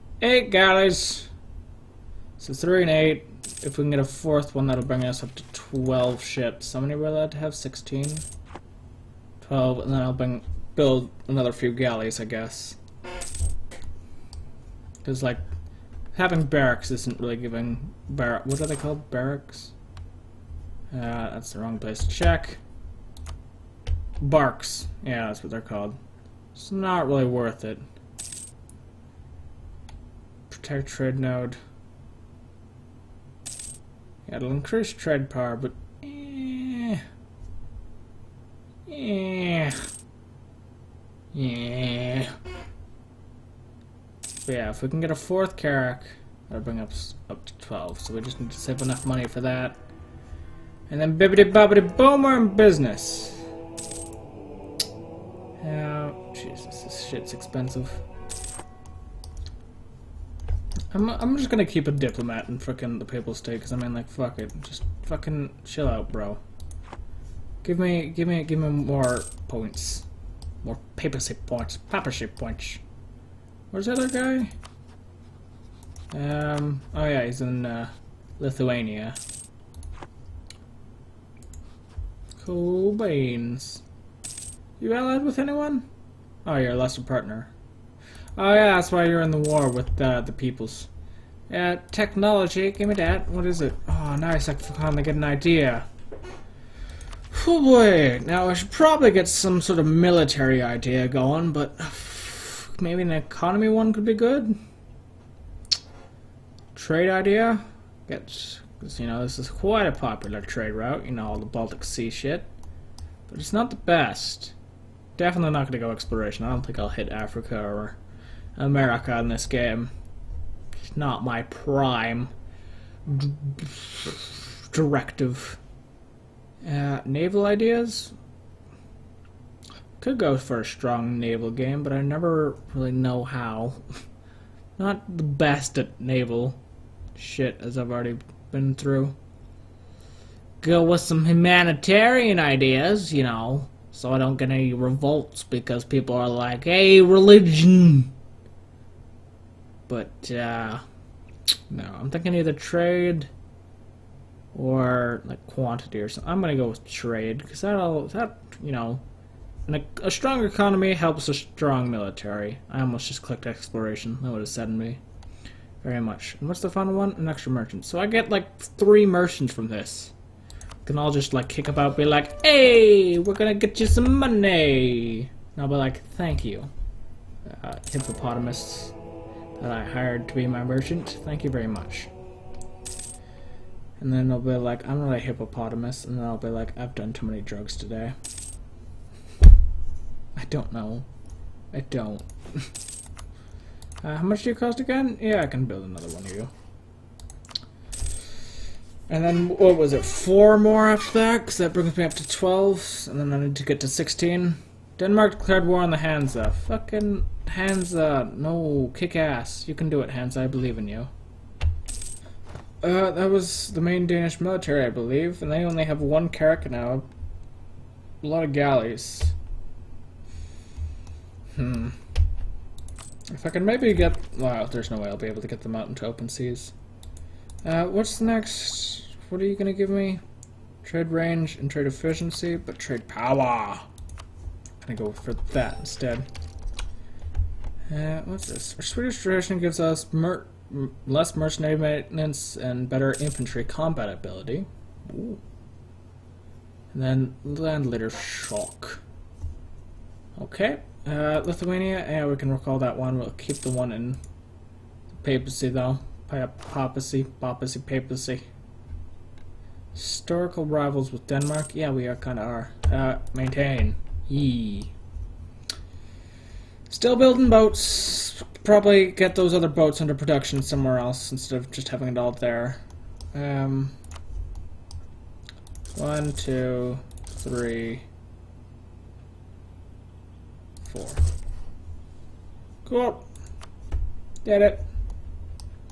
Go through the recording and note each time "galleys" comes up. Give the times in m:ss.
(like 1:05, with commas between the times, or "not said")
0:00, 0:11, 3:38.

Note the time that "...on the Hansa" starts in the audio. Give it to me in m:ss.
3:25.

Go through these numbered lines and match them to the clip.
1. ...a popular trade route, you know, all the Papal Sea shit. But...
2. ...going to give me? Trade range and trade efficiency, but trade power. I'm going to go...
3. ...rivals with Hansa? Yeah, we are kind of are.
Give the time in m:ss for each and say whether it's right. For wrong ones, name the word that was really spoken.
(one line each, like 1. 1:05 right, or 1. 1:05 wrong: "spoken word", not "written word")
1. 1:49 wrong: "Baltic", not "Papal"
2. 3:49 right
3. 4:20 wrong: "Denmark", not "Hansa".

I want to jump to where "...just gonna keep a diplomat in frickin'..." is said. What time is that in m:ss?
1:01.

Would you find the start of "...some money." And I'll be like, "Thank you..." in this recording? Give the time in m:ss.
2:53.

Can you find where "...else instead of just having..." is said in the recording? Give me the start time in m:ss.
4:30.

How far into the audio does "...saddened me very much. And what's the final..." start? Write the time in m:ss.
2:44.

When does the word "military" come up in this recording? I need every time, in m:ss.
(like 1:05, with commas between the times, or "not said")
1:39, 2:41, 3:34.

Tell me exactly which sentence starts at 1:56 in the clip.
I don't think I'll hit Africa or America in this game.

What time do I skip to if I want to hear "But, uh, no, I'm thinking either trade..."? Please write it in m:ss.
2:29.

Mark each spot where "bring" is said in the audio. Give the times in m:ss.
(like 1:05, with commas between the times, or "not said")
0:04, 0:10, 0:46, 3:21.